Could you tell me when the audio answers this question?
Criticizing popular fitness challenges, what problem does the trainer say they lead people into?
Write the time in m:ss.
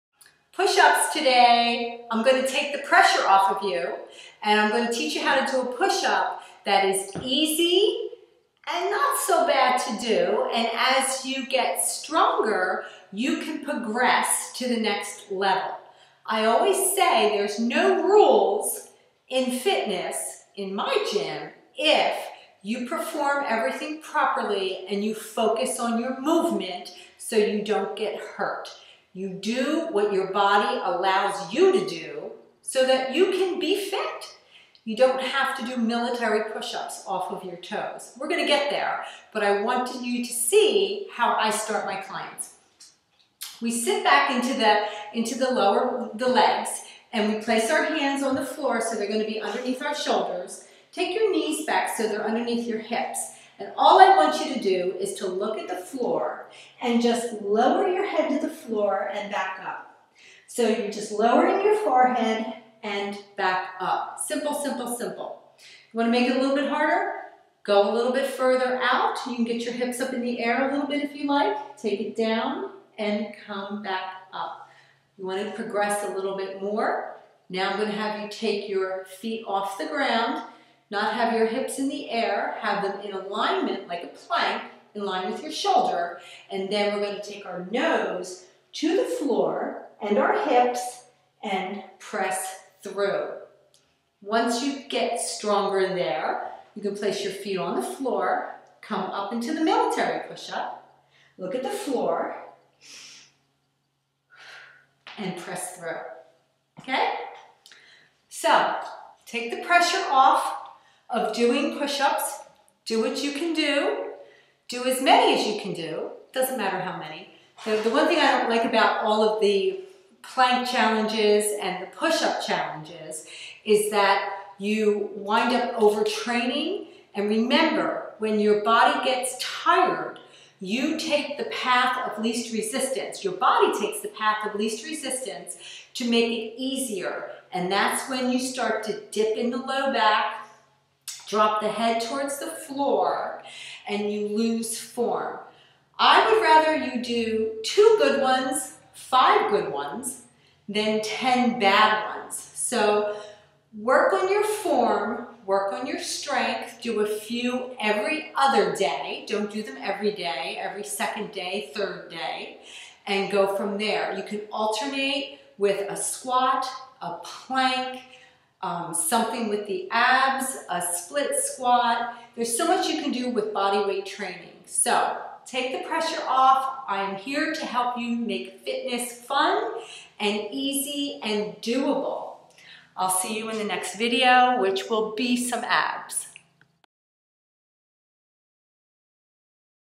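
2:05.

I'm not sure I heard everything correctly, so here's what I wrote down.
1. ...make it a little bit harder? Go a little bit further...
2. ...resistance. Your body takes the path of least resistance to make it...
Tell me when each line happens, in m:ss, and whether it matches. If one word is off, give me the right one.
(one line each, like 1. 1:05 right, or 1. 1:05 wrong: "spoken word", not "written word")
1. 1:06 right
2. 2:12 right.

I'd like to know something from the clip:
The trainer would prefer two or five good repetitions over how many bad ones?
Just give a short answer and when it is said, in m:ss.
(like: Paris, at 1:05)
10, at 2:31.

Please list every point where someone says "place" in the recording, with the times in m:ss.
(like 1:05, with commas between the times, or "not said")
0:47, 1:36.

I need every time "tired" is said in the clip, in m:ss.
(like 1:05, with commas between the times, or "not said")
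2:09.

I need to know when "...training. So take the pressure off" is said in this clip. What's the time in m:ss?
2:54.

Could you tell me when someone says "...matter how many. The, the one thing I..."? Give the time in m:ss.
1:56.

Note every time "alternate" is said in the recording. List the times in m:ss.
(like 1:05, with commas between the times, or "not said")
2:44.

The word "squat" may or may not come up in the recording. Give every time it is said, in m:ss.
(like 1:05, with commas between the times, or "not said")
2:45, 2:51.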